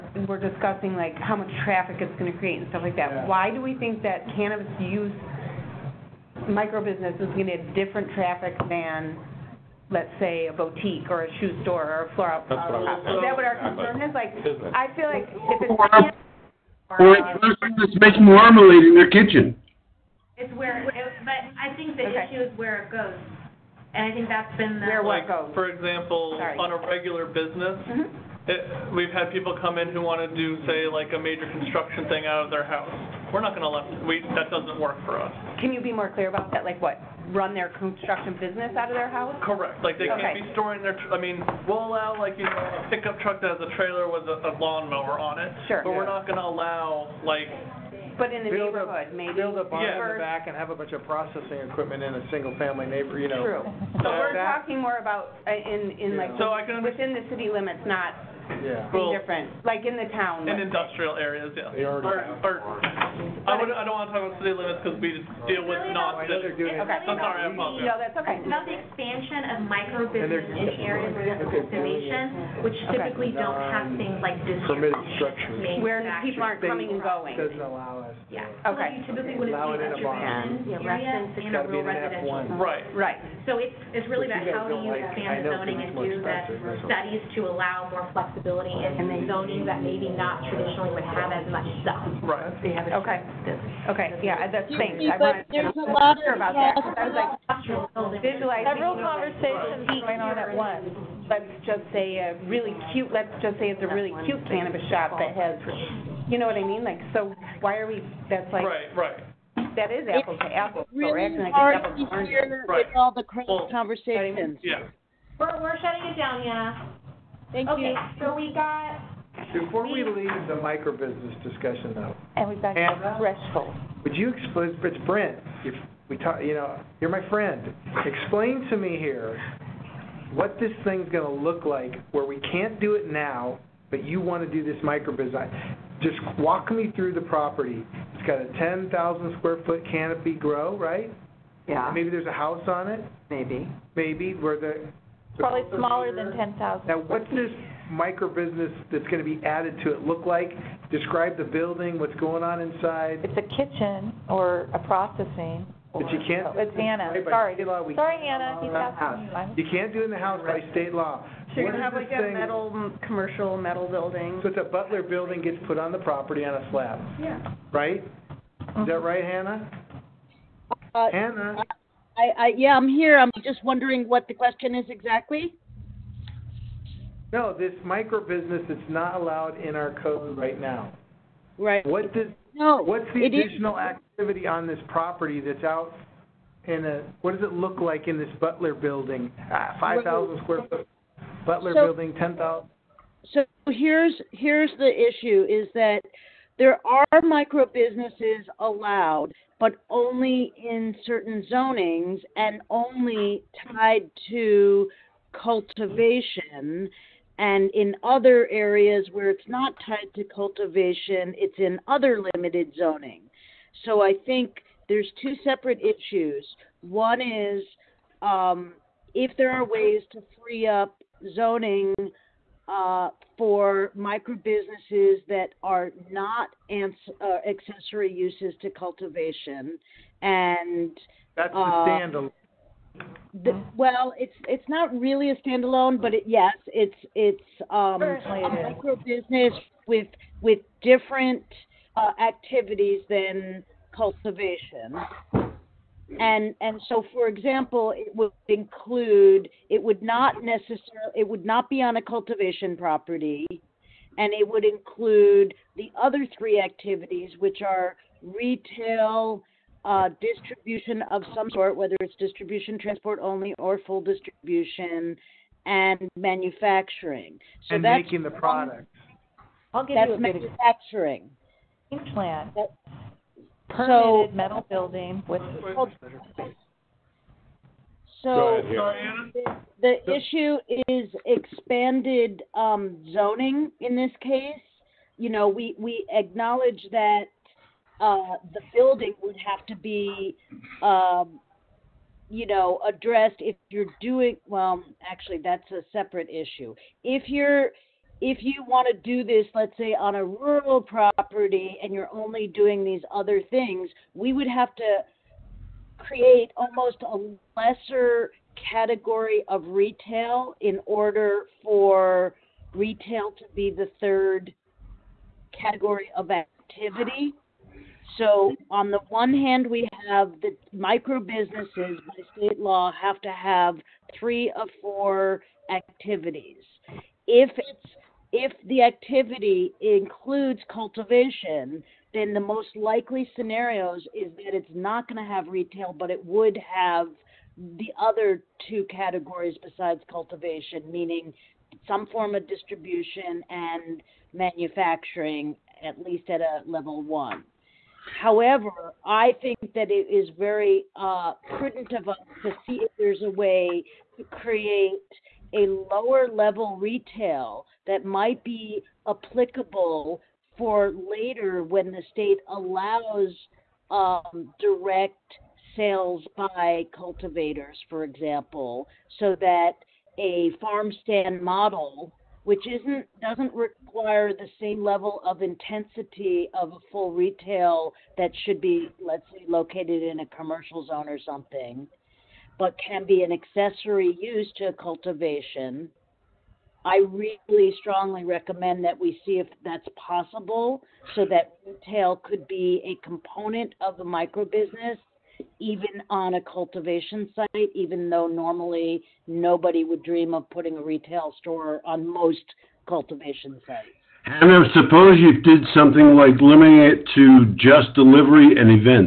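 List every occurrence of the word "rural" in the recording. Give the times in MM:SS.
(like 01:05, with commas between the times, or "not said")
01:21, 05:00.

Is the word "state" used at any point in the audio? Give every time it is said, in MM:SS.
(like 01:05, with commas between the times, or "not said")
02:40, 05:22, 06:02.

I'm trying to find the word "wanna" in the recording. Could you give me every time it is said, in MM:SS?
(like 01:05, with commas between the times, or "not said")
01:03, 02:14.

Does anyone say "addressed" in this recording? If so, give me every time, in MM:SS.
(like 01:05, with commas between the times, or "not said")
04:52.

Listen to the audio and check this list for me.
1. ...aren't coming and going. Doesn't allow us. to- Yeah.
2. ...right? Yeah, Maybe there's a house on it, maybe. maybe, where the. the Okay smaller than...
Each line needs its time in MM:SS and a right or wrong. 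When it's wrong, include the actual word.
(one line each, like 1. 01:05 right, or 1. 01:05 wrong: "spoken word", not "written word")
1. 01:16 right
2. 02:20 wrong: "Probably", not "Okay".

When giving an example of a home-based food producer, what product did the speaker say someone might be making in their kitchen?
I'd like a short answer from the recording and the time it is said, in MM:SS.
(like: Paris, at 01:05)
marmalade, at 00:18.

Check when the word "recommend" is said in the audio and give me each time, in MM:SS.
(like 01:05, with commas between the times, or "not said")
06:28.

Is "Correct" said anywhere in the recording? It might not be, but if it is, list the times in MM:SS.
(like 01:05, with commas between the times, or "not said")
00:39.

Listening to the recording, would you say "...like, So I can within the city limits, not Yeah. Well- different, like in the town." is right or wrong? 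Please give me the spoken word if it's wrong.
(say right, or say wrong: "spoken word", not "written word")
right.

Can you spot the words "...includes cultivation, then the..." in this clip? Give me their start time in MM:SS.
05:29.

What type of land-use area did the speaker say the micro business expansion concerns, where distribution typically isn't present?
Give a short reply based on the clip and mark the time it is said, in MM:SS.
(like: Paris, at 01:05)
areas of conservation, at 01:10.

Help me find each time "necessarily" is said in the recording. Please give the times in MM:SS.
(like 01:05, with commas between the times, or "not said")
04:10.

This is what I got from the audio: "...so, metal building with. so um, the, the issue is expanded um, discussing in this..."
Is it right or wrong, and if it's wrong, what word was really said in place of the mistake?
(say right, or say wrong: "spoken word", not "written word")
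wrong: "zoning", not "discussing".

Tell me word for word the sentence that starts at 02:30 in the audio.
Describe the building, what's going on inside.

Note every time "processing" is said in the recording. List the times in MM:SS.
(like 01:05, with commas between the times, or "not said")
00:51, 02:34.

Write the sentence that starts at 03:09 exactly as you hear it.
Ah, 5,000 square foot Butler so, building, 10,000.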